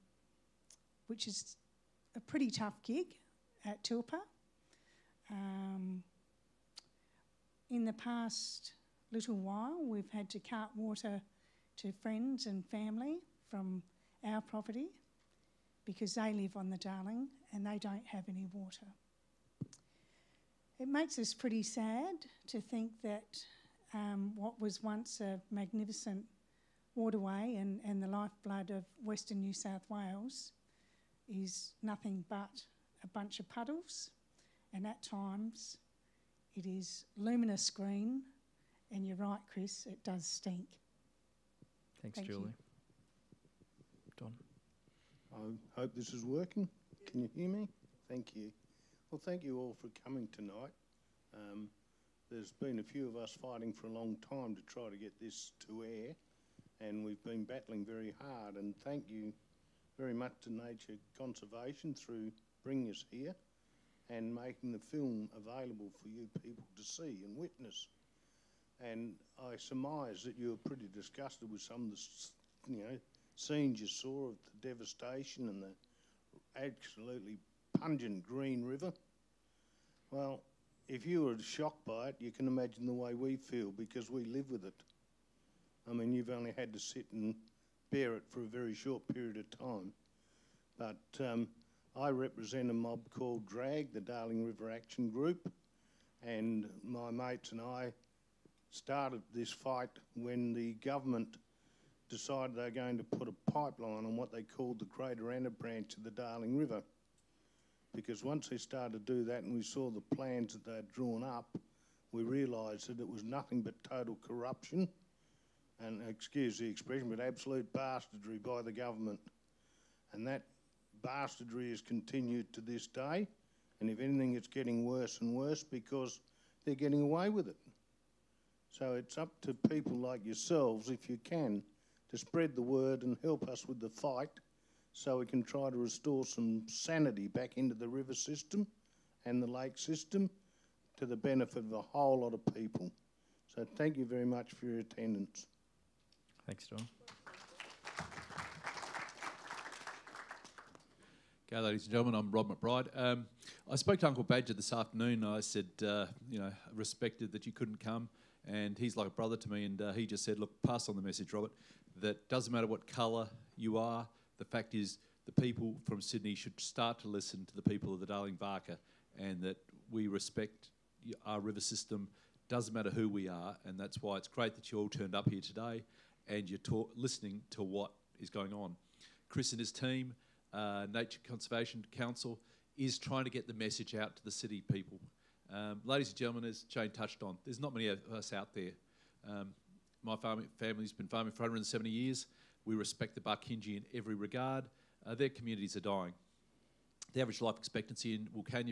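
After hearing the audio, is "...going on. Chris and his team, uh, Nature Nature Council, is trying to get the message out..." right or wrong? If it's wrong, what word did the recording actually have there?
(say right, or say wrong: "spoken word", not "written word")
wrong: "Conservation", not "Nature".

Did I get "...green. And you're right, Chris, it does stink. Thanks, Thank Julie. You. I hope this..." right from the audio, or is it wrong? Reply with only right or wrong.
right.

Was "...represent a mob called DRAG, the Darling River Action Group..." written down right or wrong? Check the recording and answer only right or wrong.
right.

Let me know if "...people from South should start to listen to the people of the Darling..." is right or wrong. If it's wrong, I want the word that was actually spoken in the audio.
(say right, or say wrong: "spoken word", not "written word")
wrong: "Sydney", not "South".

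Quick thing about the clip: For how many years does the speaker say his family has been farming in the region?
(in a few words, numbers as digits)
170.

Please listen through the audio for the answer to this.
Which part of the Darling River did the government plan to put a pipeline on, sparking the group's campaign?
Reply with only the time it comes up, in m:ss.
1:44.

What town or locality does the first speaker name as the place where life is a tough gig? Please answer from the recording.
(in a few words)
Tilpa.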